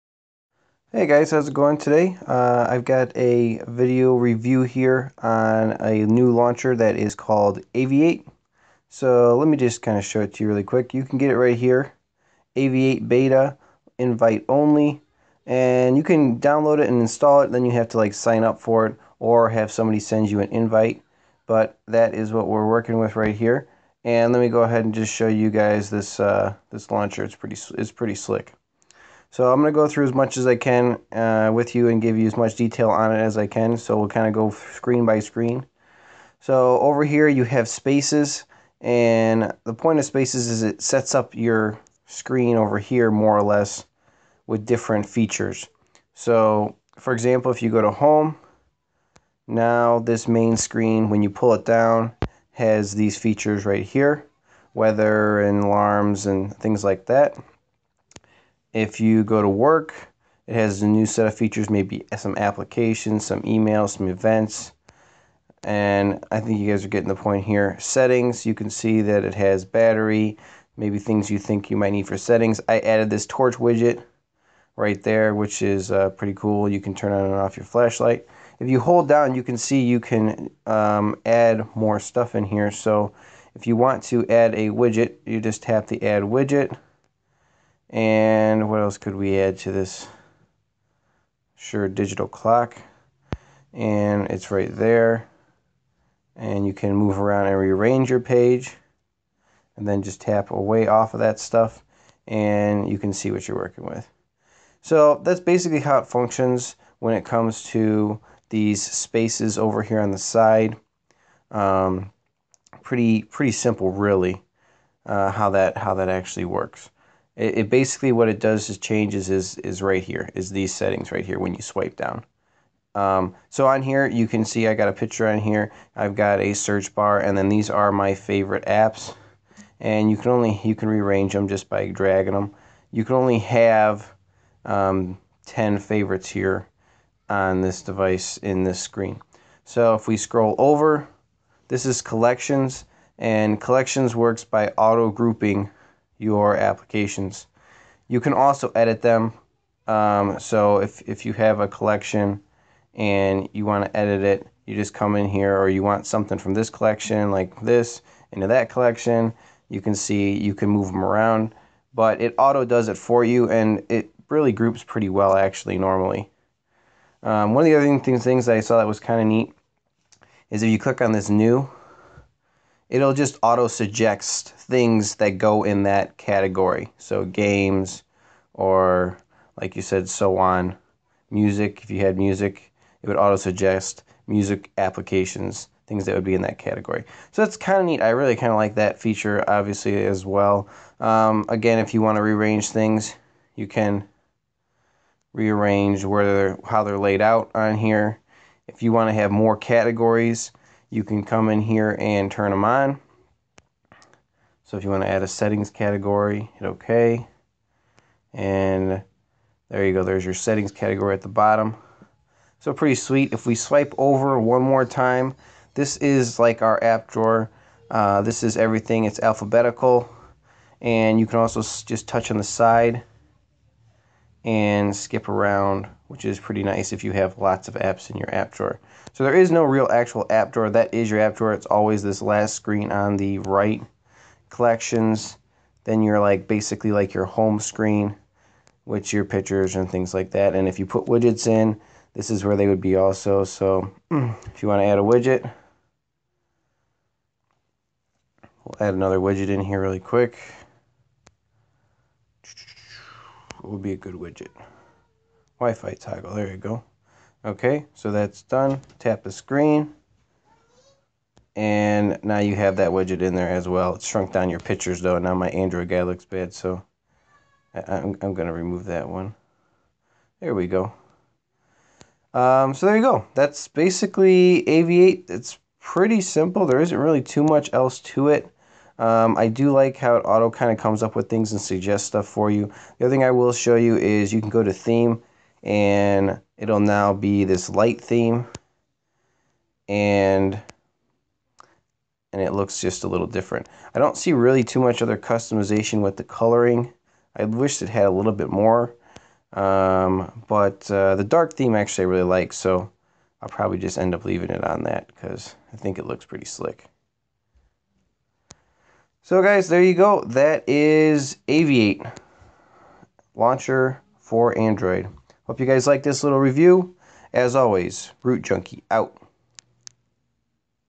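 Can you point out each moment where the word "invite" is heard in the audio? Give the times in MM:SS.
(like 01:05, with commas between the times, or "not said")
00:13, 00:20.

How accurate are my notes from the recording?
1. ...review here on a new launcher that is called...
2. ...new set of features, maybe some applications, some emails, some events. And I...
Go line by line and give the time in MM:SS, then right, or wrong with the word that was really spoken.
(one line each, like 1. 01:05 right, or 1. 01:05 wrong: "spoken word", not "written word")
1. 00:04 right
2. 01:00 right.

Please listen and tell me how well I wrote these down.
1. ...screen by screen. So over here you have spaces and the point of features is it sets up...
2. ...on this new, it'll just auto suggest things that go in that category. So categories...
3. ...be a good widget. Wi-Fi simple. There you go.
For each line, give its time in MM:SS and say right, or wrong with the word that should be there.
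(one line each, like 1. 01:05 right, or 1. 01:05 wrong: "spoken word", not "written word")
1. 00:34 wrong: "spaces", not "features"
2. 02:51 wrong: "games", not "categories"
3. 04:13 wrong: "toggle", not "simple".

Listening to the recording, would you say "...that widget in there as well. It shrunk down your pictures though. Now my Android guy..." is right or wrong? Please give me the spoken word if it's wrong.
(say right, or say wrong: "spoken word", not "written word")
right.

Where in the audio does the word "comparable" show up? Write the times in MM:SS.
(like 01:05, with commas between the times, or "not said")
not said.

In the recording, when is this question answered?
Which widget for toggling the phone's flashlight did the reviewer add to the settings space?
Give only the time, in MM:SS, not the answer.
01:13.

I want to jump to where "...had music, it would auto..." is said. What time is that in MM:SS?
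03:02.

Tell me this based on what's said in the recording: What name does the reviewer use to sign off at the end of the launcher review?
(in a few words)
RootJunky.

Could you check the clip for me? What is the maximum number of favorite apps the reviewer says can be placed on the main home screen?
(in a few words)
10.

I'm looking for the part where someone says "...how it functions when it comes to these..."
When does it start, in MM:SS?
01:45.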